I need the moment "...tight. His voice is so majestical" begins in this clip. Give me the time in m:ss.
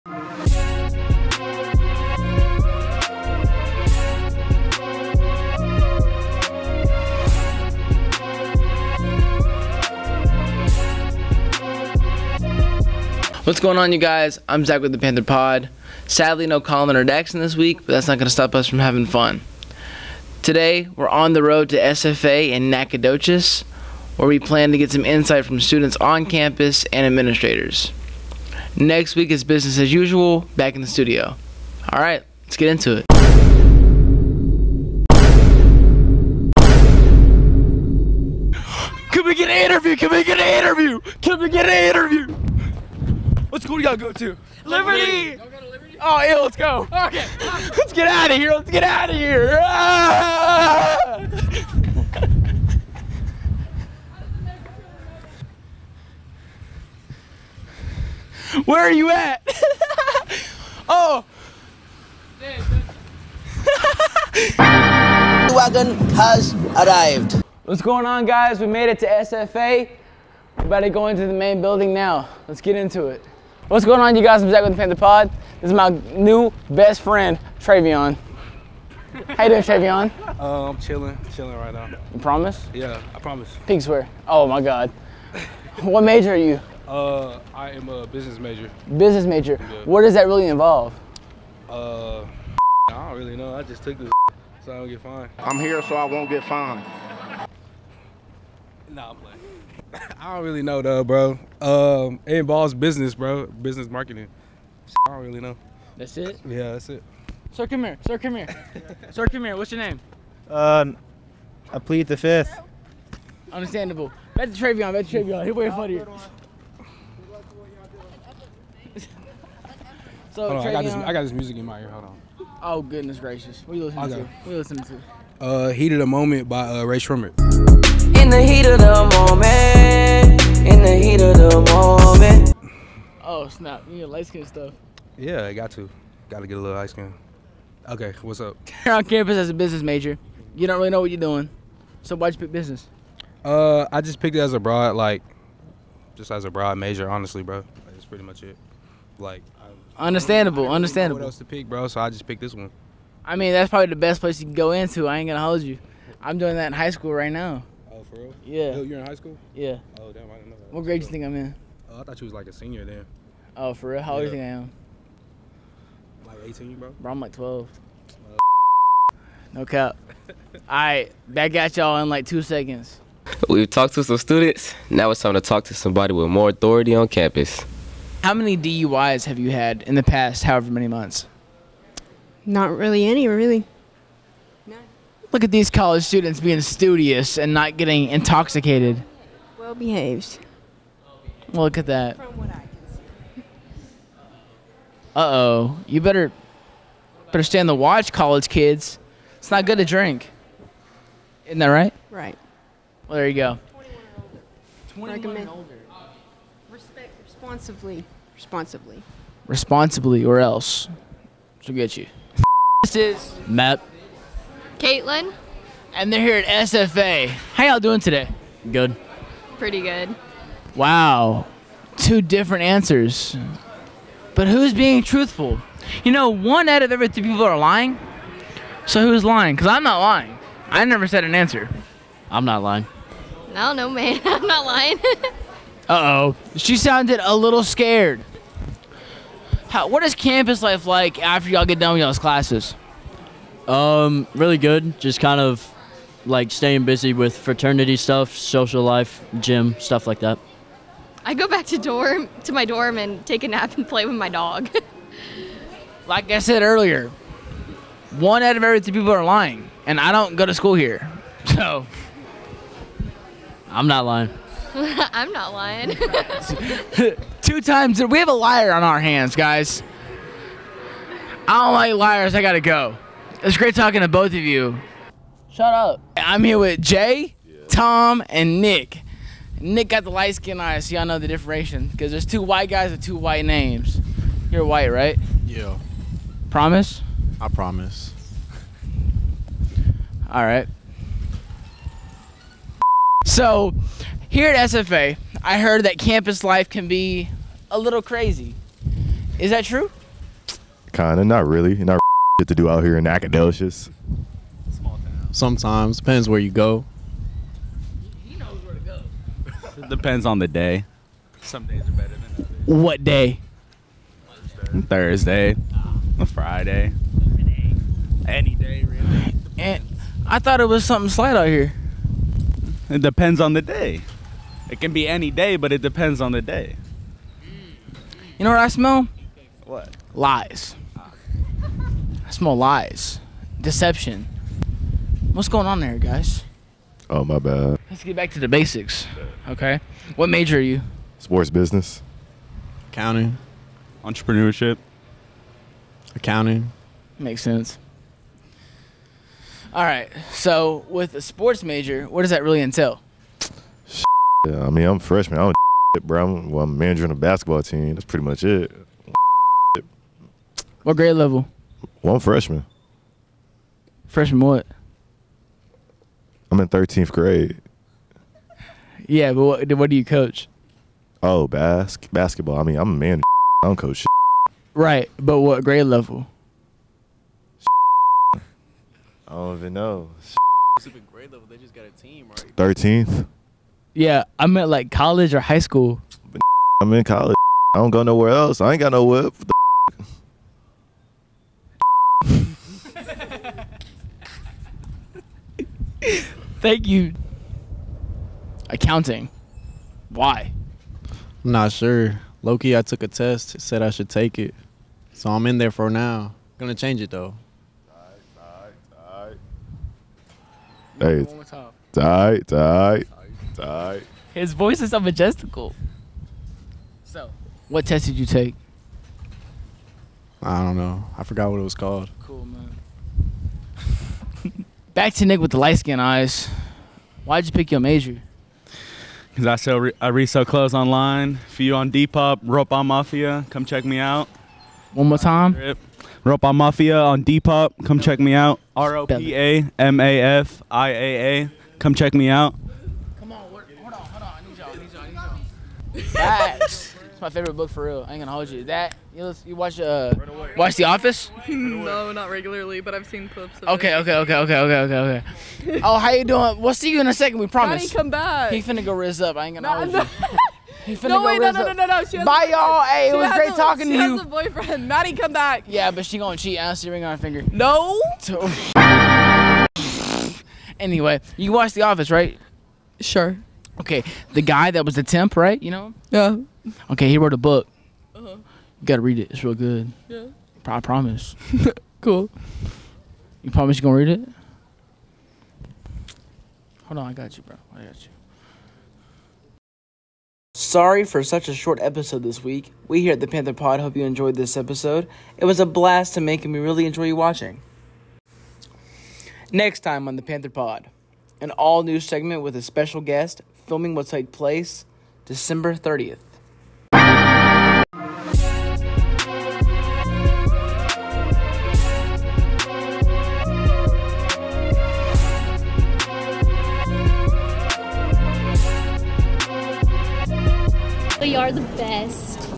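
6:53.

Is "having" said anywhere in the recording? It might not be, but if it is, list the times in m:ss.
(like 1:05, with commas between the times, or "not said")
0:18.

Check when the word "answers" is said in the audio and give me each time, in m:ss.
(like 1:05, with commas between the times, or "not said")
3:42, 3:51.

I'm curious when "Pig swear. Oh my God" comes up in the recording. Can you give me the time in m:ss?
1:23.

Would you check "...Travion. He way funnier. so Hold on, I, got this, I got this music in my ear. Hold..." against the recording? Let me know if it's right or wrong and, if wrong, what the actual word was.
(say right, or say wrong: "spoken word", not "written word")
right.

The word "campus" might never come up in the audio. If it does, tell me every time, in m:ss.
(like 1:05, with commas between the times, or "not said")
0:26, 2:19, 2:57, 4:00, 4:55.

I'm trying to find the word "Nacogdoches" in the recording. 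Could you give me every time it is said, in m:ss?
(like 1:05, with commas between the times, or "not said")
0:22, 5:03.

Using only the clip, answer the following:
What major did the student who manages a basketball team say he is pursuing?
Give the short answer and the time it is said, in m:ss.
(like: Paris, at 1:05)
Sports business, at 5:41.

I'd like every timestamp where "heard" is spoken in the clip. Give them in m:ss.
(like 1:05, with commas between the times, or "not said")
4:55.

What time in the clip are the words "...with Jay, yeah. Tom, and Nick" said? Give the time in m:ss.
4:36.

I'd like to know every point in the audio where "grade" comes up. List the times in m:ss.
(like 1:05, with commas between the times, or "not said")
2:40, 6:00, 6:07, 6:15, 6:21.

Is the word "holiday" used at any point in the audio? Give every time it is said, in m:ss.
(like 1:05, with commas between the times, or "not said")
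not said.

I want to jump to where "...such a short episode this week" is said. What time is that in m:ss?
8:11.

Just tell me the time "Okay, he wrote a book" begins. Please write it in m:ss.
7:56.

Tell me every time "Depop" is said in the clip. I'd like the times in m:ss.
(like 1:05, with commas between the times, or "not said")
7:11, 7:17.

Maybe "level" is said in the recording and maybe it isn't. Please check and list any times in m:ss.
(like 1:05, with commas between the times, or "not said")
6:01, 6:15, 6:21.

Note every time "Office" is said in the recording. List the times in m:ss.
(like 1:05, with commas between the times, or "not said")
7:30, 7:51.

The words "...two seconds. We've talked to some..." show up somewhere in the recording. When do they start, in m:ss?
2:52.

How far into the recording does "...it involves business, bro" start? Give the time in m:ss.
1:42.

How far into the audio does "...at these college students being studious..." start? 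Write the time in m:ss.
3:05.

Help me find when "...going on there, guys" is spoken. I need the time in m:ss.
5:35.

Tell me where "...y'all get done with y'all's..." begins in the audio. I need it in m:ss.
4:01.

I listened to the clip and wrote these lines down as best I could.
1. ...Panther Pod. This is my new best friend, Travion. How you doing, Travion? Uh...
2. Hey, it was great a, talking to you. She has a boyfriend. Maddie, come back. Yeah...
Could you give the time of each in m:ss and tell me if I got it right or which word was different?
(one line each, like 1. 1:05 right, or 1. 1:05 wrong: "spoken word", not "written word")
1. 1:14 right
2. 7:42 right.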